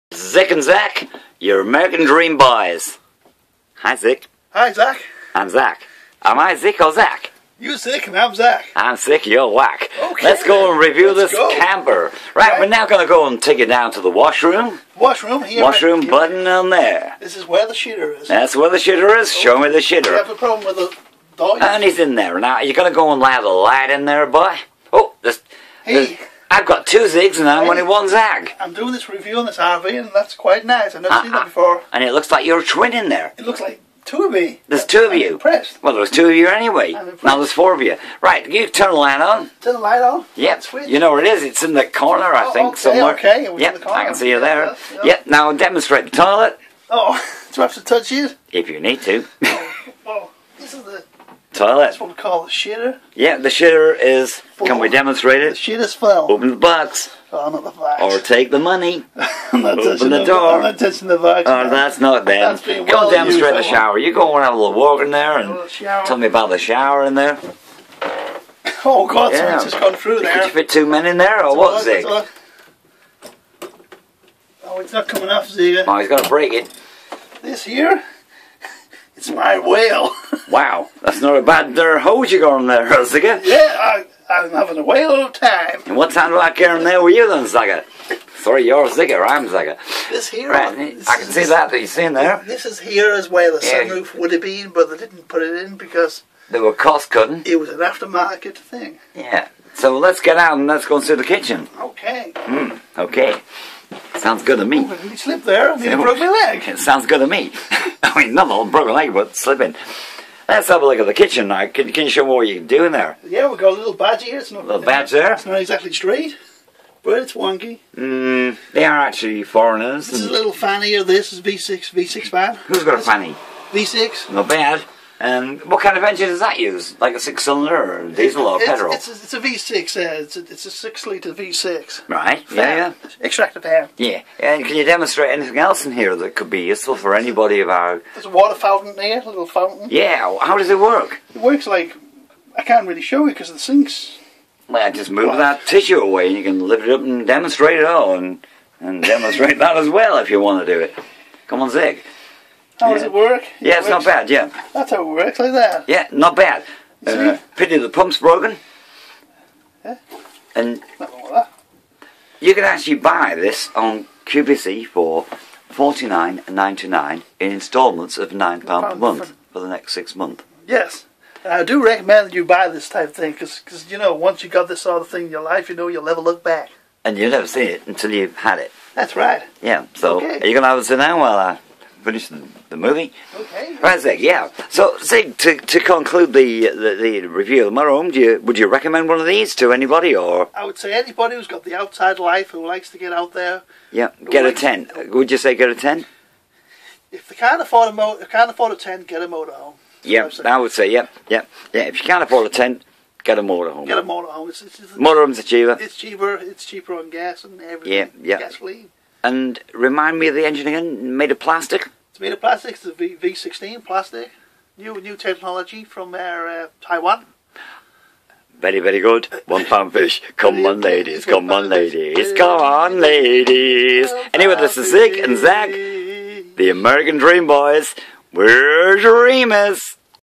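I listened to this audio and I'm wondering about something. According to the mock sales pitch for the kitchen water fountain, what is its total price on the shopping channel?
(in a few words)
$49.99.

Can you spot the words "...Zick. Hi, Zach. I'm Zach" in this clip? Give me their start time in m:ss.
0:03.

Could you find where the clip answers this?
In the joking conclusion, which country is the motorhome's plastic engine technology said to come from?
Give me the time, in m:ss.
3:36.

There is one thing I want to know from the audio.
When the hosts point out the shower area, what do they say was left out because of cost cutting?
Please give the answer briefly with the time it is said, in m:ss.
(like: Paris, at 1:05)
sunroof, at 1:33.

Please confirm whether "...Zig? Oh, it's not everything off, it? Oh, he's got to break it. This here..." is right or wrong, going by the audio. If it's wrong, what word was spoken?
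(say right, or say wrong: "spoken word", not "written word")
wrong: "coming", not "everything".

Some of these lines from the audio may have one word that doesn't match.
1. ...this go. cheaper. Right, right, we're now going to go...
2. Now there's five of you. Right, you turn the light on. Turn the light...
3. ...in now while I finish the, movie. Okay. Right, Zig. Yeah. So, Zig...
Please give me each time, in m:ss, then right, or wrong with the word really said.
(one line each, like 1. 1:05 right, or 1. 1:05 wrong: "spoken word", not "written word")
1. 0:11 wrong: "camper", not "cheaper"
2. 0:37 wrong: "four", not "five"
3. 3:00 right.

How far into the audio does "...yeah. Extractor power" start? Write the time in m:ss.
2:13.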